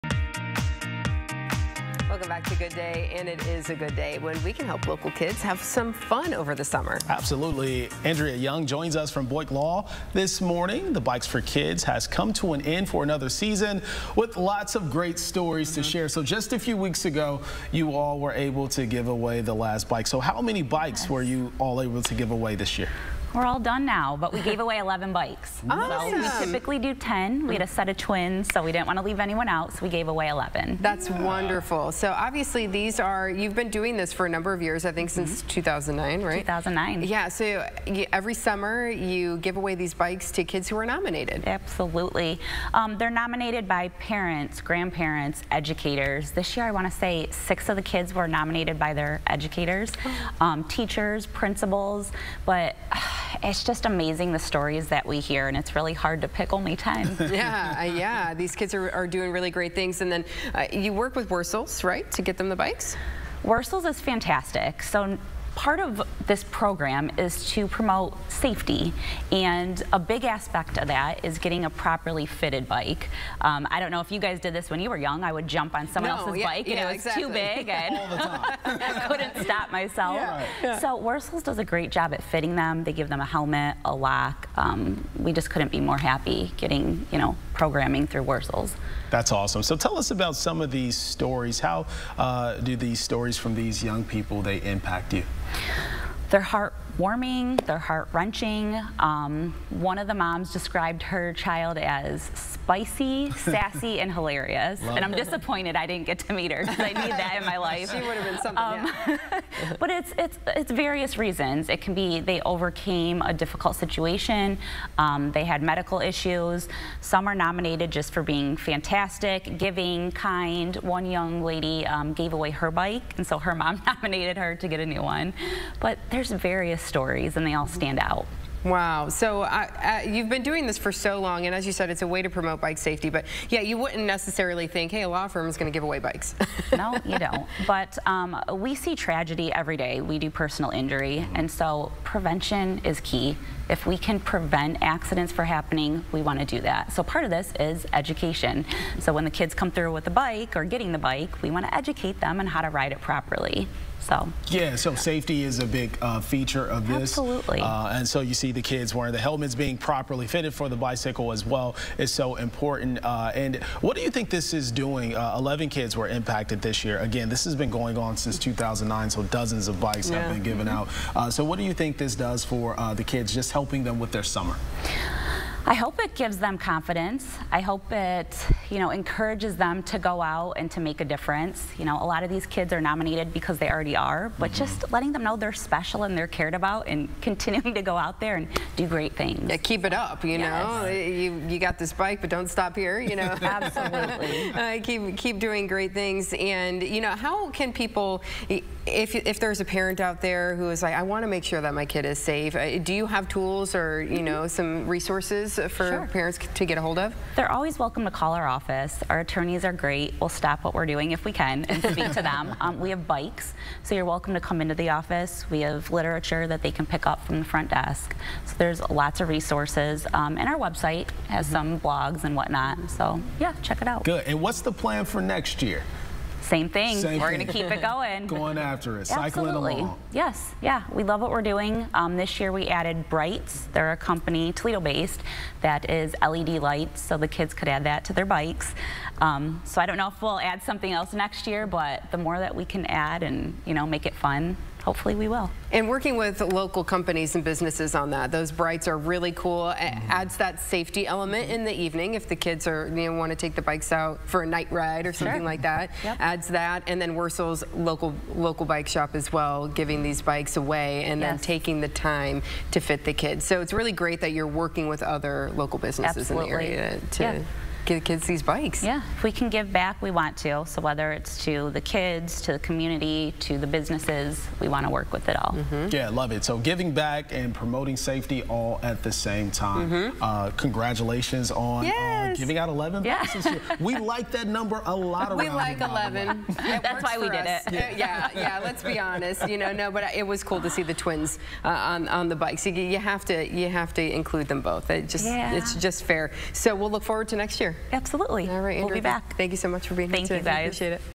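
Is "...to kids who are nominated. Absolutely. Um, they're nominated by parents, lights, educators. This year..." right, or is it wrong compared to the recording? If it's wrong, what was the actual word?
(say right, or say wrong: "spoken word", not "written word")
wrong: "grandparents", not "lights".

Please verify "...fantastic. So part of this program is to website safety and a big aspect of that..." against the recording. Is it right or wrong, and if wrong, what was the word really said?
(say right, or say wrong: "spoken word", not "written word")
wrong: "promote", not "website".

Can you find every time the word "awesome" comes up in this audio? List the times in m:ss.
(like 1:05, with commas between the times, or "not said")
0:25, 1:29.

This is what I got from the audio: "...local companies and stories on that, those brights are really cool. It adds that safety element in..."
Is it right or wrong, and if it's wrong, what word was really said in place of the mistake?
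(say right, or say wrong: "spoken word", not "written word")
wrong: "businesses", not "stories".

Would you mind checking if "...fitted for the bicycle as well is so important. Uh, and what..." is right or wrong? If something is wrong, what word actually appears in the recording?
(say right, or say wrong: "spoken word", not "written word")
right.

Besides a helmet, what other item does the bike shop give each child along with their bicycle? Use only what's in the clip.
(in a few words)
A lock.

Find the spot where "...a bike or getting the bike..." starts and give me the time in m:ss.
2:30.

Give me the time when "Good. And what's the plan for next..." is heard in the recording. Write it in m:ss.
3:44.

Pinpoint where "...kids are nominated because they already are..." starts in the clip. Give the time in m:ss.
3:02.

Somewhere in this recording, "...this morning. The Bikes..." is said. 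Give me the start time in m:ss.
0:10.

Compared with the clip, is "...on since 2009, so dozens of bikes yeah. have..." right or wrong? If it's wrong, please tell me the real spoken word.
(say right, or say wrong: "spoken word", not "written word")
right.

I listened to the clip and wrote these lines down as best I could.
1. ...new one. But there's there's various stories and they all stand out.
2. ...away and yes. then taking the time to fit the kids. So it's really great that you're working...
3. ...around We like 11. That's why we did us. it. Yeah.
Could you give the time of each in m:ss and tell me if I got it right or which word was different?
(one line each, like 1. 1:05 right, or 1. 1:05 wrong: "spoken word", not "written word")
1. 2:04 right
2. 4:20 right
3. 4:45 right.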